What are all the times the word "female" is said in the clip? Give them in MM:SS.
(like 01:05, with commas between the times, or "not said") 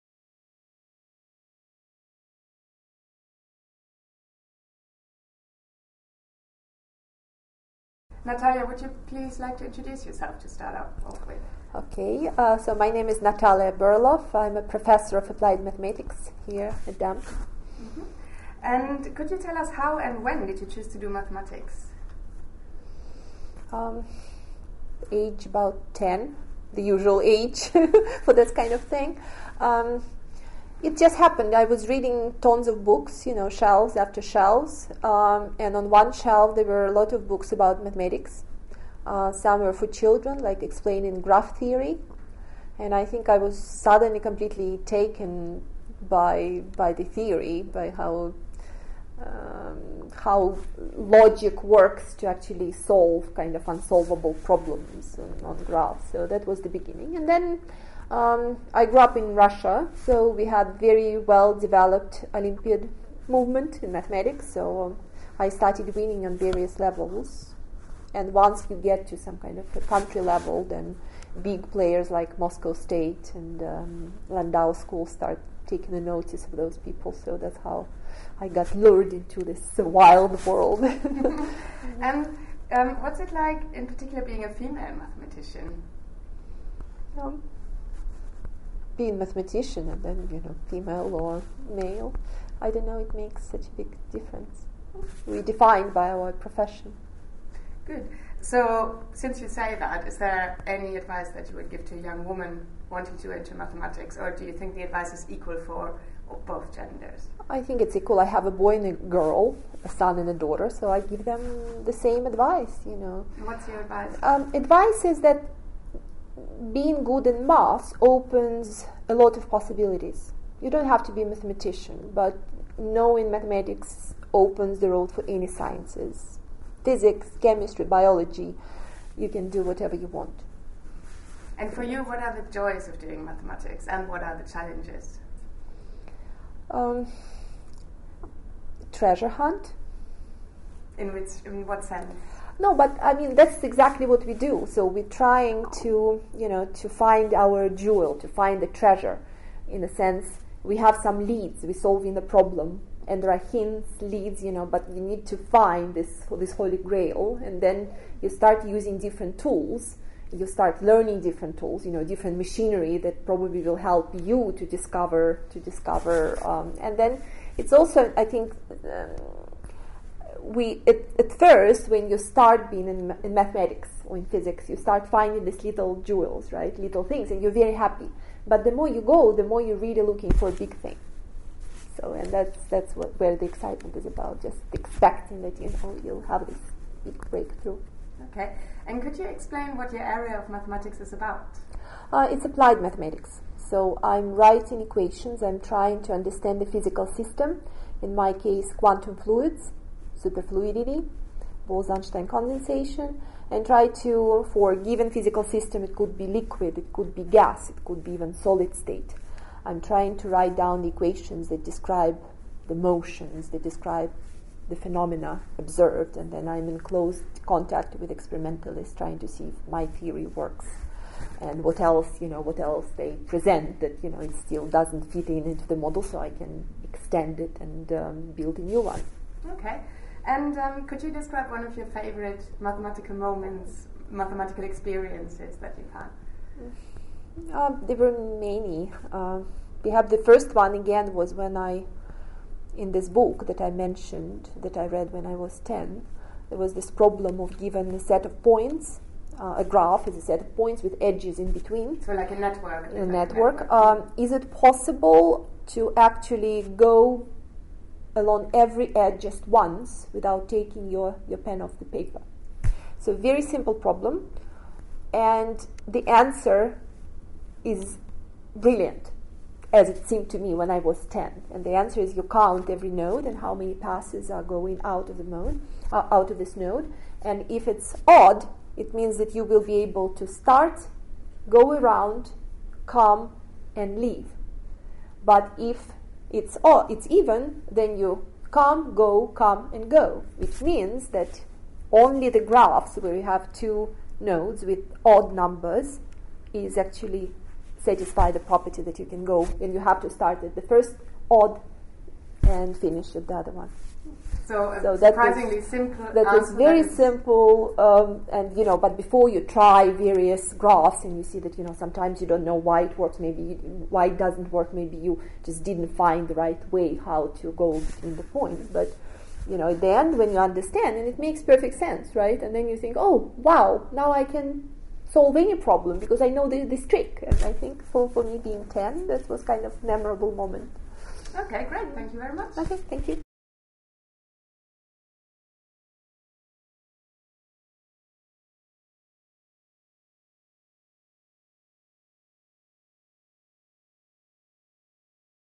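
01:24, 01:30.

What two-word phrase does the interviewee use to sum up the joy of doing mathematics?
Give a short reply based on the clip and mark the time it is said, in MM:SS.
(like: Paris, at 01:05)
Treasure hunt, at 02:18.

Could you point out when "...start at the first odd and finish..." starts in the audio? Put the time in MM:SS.
05:00.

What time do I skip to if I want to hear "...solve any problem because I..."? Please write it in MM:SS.
05:25.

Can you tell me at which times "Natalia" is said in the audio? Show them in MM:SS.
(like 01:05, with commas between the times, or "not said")
00:08, 00:13.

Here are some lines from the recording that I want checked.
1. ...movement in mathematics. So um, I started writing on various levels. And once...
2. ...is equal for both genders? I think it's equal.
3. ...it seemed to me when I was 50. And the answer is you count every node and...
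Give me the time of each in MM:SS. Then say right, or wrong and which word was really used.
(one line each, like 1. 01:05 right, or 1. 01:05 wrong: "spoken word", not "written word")
1. 01:03 wrong: "winning", not "writing"
2. 01:45 right
3. 04:29 wrong: "10", not "50".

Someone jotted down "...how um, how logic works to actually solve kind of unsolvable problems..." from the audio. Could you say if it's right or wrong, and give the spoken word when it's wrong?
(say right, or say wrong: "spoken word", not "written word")
right.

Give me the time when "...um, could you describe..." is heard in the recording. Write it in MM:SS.
03:50.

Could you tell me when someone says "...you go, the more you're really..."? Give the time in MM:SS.
02:58.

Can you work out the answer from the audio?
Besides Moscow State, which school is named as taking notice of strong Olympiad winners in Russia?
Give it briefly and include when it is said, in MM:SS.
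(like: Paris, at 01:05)
Landau School, at 01:14.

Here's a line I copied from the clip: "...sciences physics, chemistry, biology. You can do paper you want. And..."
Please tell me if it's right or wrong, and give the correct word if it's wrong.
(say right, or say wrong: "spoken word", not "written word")
wrong: "whatever", not "paper".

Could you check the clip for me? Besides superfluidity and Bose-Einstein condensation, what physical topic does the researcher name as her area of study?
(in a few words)
Quantum fluids.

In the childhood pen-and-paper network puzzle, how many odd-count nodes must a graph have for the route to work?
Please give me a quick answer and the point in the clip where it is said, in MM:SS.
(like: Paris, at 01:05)
2, at 04:53.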